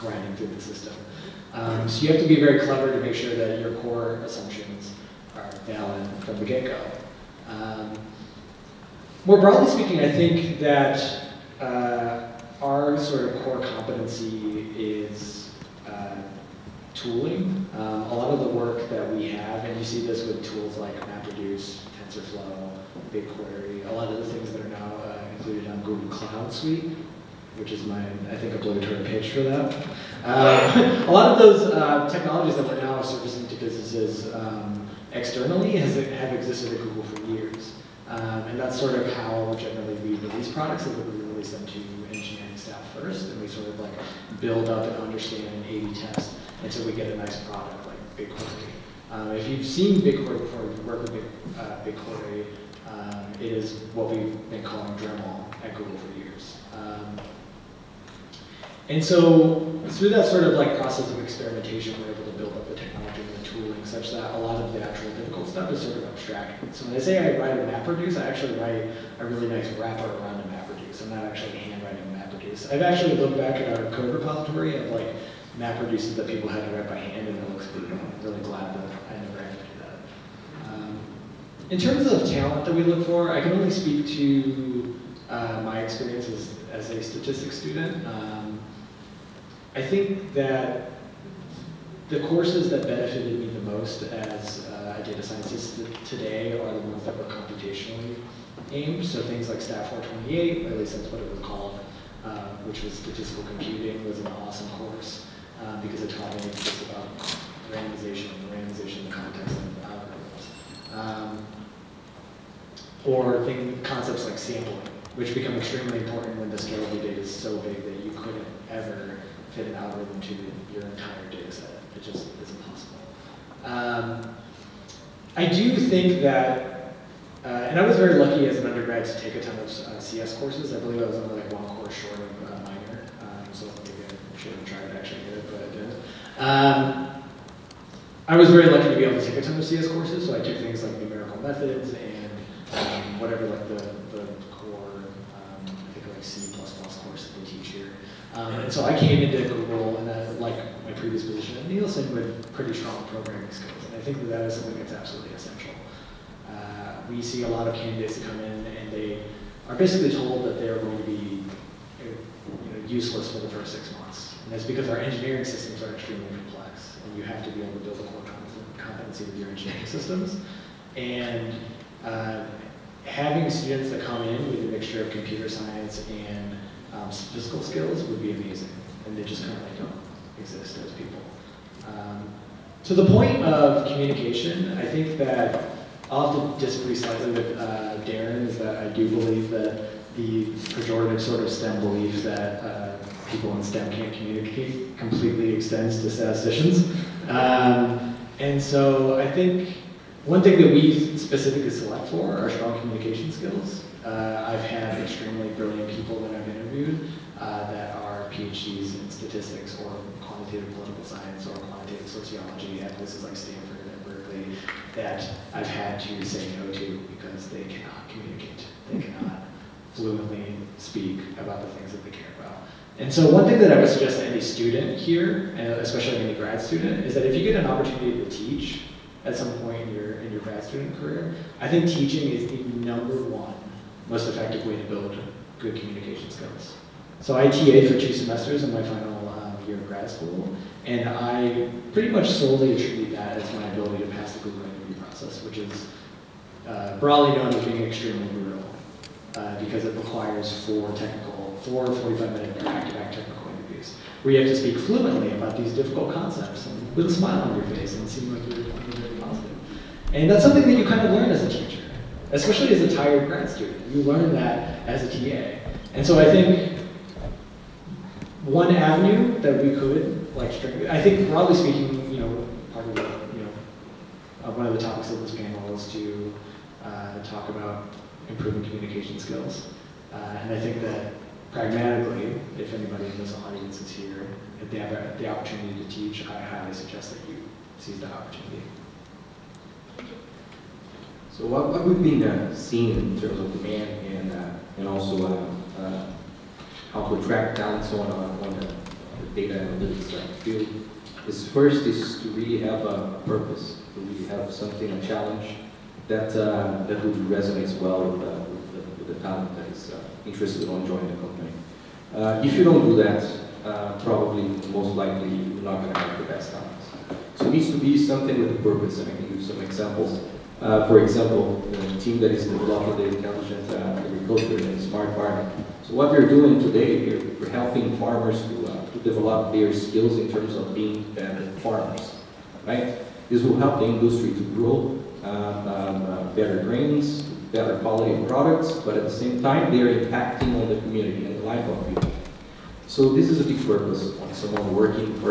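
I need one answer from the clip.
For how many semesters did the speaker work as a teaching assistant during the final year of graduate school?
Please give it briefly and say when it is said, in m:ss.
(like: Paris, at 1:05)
2, at 3:57.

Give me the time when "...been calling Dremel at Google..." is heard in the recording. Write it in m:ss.
0:54.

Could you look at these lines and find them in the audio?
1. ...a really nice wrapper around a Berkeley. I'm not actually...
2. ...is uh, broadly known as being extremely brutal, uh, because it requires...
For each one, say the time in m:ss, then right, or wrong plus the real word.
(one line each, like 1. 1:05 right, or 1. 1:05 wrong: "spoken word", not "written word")
1. 1:09 wrong: "MapReduce", not "Berkeley"
2. 4:05 right.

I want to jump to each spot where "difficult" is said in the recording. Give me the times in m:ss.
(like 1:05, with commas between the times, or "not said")
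1:05, 4:15.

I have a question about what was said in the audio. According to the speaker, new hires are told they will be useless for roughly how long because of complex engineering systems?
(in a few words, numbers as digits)
6 months.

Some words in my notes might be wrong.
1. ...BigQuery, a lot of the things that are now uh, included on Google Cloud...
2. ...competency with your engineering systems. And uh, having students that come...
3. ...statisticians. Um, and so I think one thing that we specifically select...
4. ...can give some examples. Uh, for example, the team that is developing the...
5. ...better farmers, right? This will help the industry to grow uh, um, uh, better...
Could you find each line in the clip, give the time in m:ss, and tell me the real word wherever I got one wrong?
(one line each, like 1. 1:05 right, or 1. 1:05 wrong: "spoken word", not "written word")
1. 0:23 right
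2. 2:48 right
3. 3:16 right
4. 5:19 right
5. 5:31 right.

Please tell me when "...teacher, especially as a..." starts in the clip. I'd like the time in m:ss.
4:21.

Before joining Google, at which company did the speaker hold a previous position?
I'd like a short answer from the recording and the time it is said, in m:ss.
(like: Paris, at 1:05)
Nielsen, at 2:31.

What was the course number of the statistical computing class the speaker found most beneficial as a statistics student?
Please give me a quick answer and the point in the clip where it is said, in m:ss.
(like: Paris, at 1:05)
STAT 428, at 1:39.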